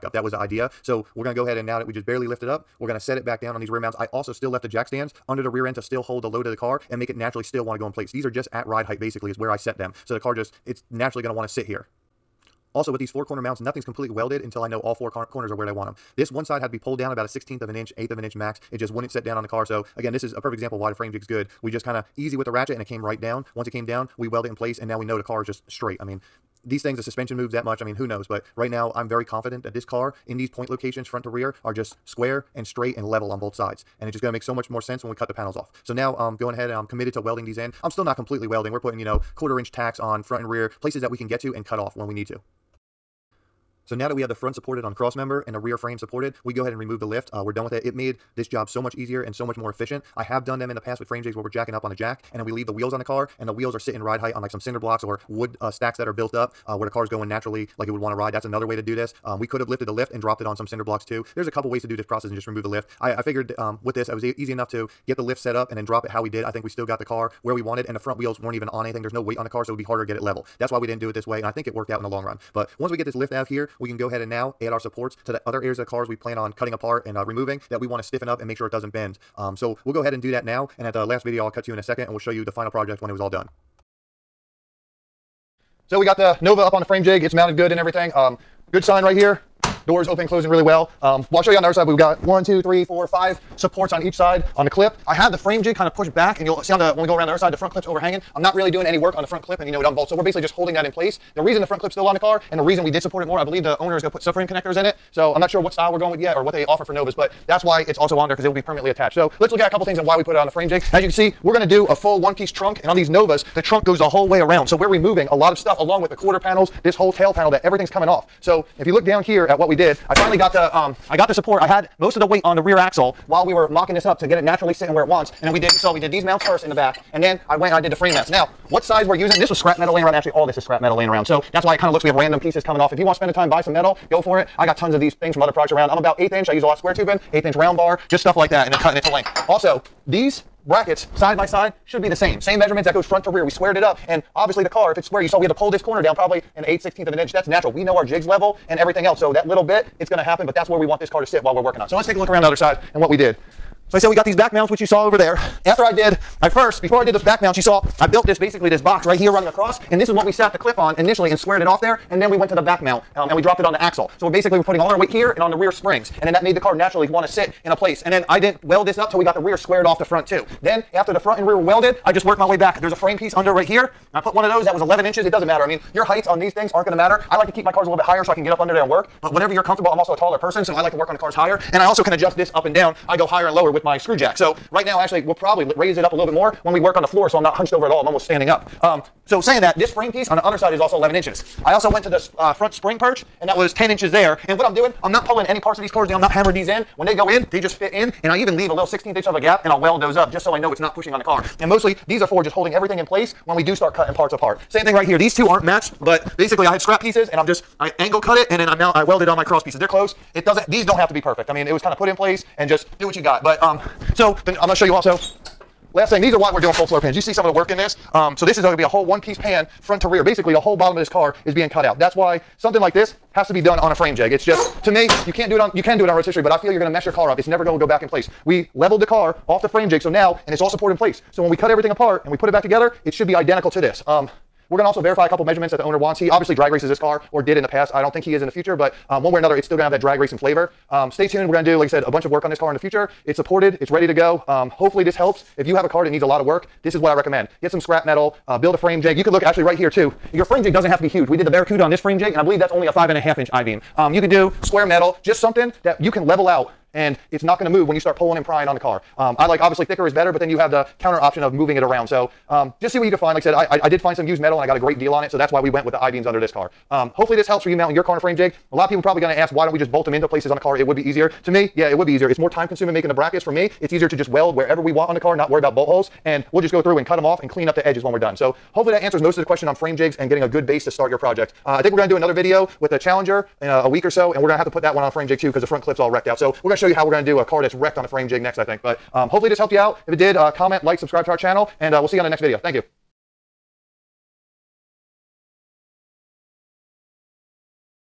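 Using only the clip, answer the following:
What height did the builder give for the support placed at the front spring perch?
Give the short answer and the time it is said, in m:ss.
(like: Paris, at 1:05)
10 inches, at 3:13.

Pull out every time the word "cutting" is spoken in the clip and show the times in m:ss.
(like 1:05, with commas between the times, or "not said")
1:16, 2:18, 3:23.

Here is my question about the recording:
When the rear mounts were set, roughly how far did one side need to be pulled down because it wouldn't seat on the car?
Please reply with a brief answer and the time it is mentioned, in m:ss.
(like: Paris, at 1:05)
1/16 inch, at 0:17.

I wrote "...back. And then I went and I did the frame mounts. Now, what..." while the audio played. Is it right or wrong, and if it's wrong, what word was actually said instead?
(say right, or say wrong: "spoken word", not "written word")
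right.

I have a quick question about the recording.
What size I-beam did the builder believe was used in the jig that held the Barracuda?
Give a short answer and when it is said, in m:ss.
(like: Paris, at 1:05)
5 1/2 inch, at 4:12.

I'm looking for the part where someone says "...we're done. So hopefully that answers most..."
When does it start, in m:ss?
4:38.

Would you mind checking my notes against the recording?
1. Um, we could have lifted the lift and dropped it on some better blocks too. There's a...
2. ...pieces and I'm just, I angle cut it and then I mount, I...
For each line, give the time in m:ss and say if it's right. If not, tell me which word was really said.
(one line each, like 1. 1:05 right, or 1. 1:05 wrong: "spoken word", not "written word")
1. 0:59 wrong: "cinder", not "better"
2. 3:27 right.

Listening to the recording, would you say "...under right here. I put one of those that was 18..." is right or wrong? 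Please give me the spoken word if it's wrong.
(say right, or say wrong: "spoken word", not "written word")
wrong: "11", not "18".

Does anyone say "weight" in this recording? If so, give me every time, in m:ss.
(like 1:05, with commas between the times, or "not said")
1:09, 2:02, 2:44.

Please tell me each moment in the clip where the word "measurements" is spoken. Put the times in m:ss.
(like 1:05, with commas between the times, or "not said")
2:22, 3:55.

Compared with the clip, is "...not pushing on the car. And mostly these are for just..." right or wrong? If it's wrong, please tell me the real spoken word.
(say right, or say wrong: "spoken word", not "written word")
right.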